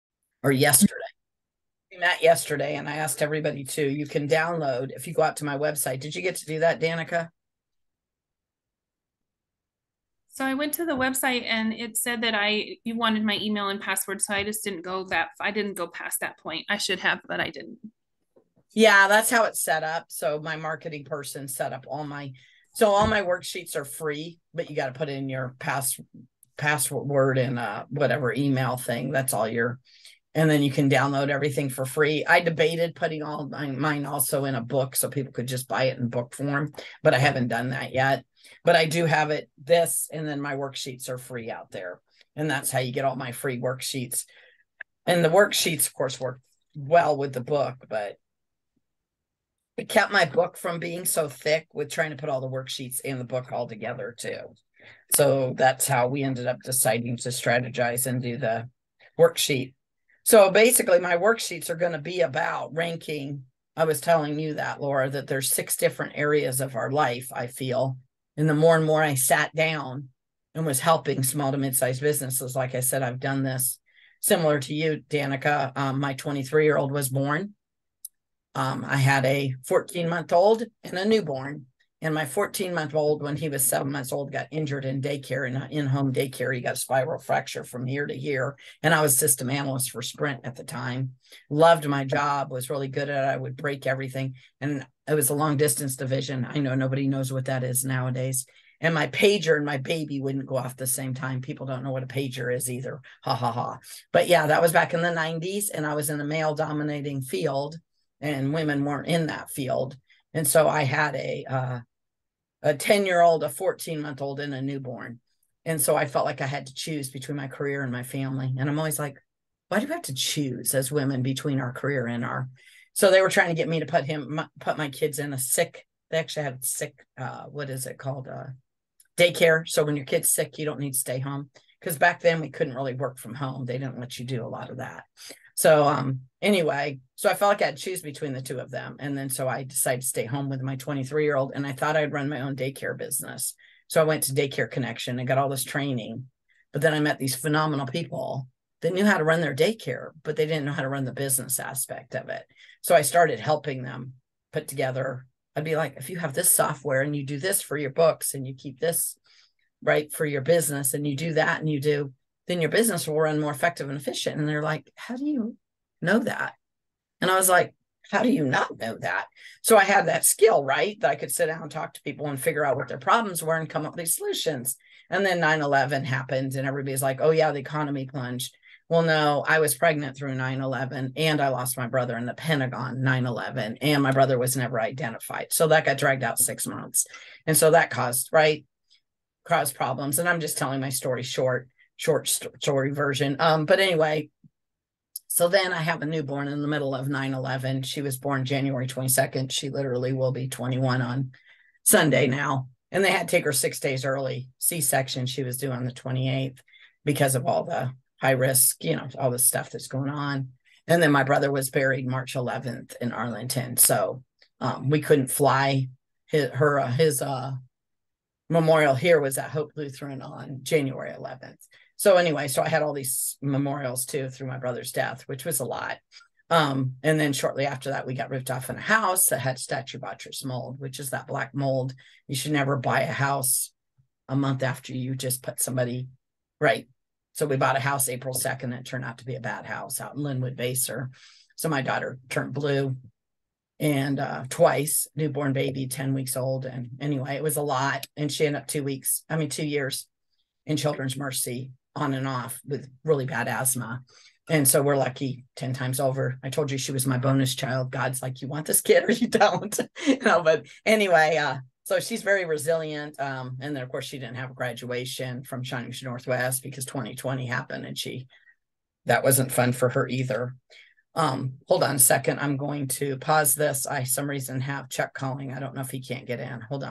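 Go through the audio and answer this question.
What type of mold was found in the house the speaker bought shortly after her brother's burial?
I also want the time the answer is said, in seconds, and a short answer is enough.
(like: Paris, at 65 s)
Stachybotrys, at 229 s.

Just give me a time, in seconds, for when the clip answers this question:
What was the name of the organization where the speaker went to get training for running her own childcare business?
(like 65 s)
144 s.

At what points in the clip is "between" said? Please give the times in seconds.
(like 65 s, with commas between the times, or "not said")
117 s, 121 s, 138 s.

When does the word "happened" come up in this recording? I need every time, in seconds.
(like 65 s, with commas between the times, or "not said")
176 s, 267 s.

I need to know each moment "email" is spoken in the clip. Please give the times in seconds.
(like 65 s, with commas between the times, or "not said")
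13 s, 28 s.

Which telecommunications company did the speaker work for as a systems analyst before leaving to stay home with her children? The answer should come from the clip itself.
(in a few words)
Sprint.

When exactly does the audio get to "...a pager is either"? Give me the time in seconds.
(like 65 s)
102 s.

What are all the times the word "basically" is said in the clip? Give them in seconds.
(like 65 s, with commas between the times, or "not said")
60 s.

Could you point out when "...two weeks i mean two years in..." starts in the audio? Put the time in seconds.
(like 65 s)
248 s.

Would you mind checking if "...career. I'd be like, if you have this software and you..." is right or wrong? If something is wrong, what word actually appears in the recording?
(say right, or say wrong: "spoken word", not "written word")
wrong: "together", not "career".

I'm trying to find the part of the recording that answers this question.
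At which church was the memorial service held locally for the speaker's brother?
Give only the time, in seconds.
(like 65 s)
219 s.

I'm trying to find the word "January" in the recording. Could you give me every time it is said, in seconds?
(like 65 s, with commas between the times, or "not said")
198 s, 220 s.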